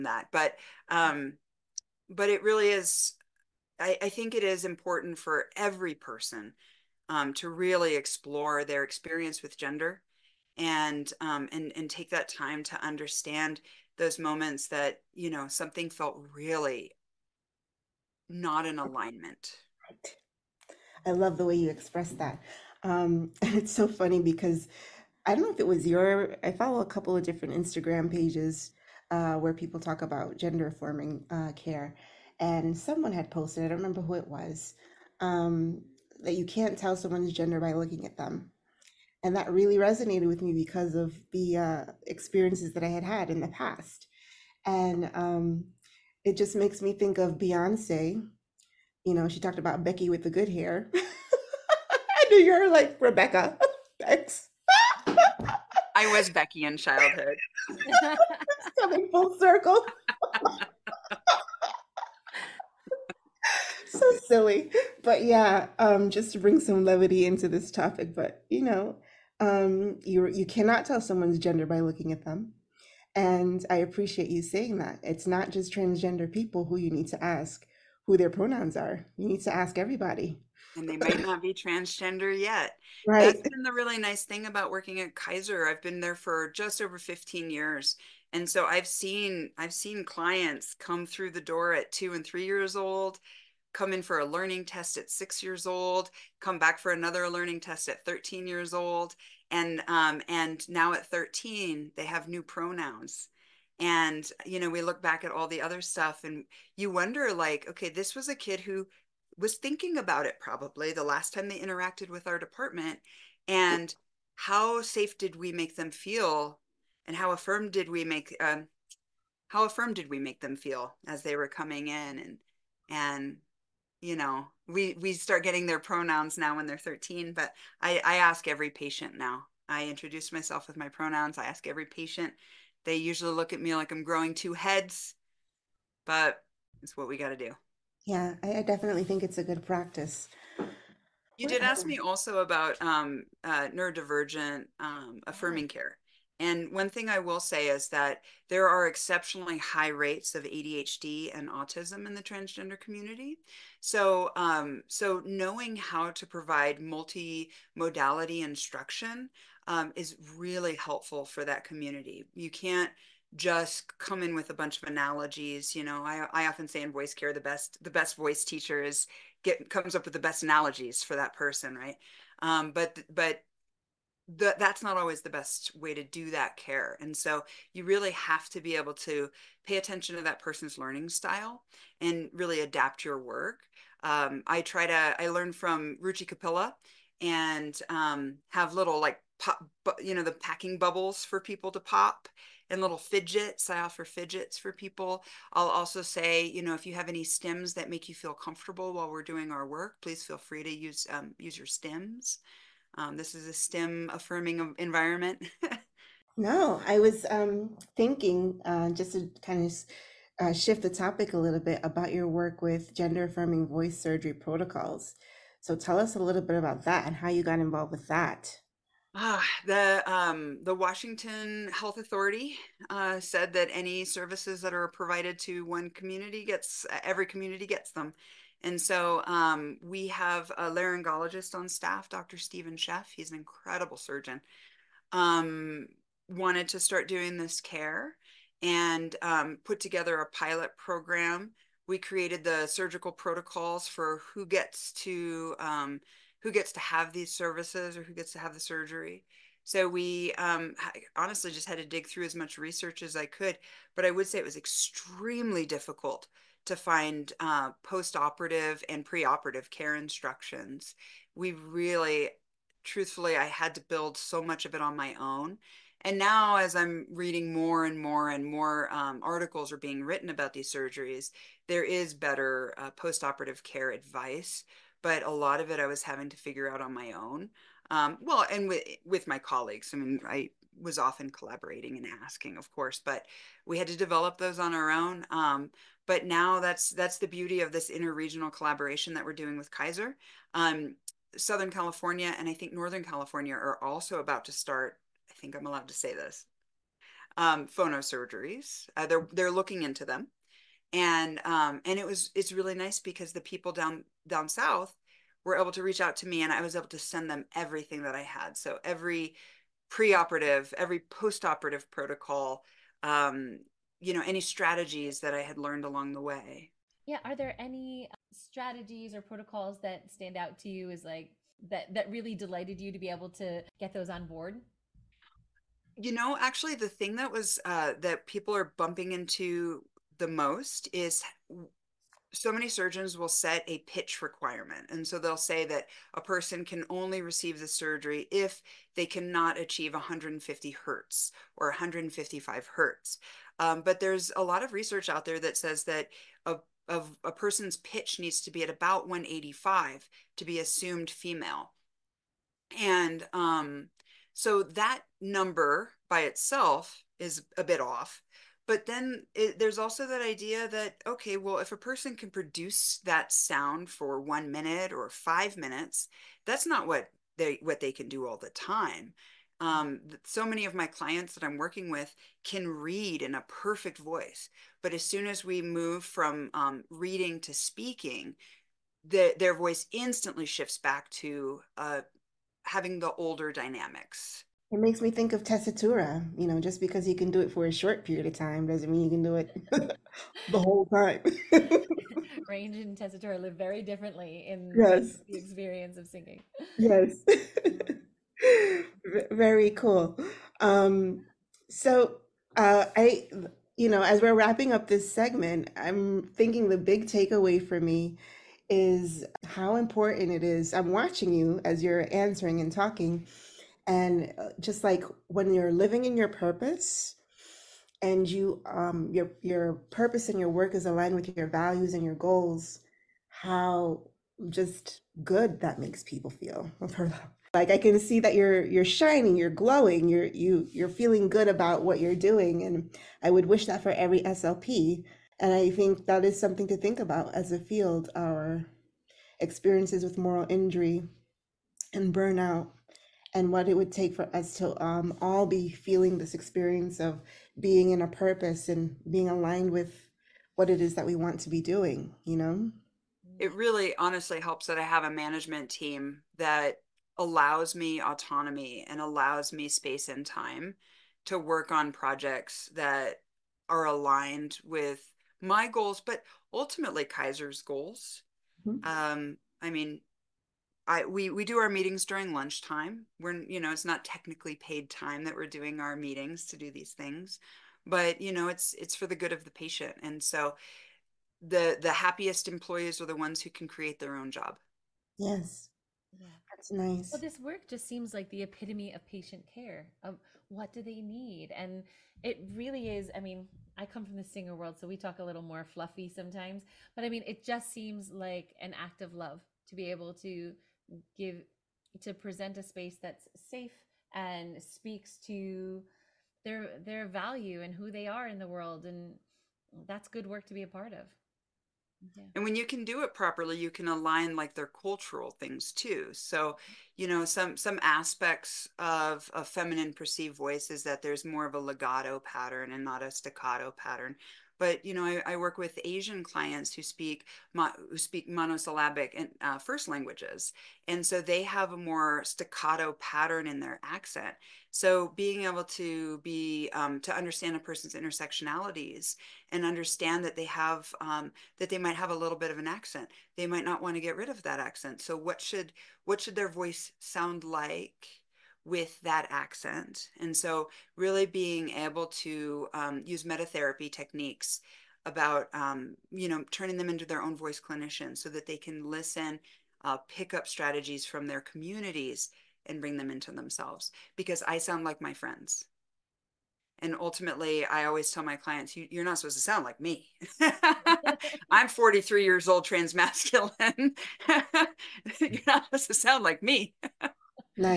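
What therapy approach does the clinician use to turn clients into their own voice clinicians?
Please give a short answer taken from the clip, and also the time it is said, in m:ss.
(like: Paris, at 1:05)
metatherapy, at 9:13.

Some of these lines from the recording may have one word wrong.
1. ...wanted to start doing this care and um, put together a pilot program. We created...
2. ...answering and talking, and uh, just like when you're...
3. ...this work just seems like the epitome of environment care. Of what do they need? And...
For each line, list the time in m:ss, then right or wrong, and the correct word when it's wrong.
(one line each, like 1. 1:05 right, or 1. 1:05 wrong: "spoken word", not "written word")
1. 3:56 right
2. 6:52 right
3. 8:07 wrong: "patient", not "environment".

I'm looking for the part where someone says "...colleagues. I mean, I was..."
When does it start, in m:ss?
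4:39.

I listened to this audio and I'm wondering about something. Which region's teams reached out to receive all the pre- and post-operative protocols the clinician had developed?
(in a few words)
Southern California.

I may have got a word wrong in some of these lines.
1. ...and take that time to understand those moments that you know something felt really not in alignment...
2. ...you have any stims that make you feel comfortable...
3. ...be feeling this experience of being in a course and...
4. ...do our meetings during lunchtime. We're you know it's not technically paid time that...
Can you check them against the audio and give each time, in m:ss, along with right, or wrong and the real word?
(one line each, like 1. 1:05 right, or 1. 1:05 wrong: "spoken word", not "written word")
1. 0:11 right
2. 3:16 right
3. 7:25 wrong: "purpose", not "course"
4. 7:51 right.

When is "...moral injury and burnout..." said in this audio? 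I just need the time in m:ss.
7:20.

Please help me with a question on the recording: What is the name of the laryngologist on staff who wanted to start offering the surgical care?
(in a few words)
Dr. Stephen Sheff.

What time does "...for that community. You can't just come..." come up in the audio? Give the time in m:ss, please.
2:41.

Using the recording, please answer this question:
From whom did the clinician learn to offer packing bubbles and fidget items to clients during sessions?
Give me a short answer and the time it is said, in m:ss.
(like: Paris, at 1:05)
Ruchi Capilla, at 3:06.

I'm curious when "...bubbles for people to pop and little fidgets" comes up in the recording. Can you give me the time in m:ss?
3:10.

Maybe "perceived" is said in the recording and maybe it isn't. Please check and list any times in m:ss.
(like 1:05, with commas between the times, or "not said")
8:39.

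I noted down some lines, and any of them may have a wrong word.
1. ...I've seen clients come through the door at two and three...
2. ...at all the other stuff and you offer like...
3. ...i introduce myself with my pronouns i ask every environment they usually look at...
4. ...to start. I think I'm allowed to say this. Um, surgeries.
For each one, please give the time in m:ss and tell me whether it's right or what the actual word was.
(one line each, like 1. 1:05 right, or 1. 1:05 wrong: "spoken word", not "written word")
1. 1:29 right
2. 1:45 wrong: "wonder", not "offer"
3. 2:09 wrong: "patient", not "environment"
4. 4:54 right.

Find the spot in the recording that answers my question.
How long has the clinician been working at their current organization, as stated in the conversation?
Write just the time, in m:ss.
1:26.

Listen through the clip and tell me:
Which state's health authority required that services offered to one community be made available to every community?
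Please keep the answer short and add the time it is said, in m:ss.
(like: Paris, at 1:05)
Washington, at 3:40.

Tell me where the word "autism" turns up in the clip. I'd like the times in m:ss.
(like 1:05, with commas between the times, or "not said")
2:31.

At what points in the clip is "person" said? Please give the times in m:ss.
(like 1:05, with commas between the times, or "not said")
0:05, 2:51, 3:00, 5:36, 5:47, 6:01, 8:57.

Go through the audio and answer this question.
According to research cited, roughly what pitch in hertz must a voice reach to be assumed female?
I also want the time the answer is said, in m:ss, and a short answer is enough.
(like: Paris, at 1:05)
185, at 5:49.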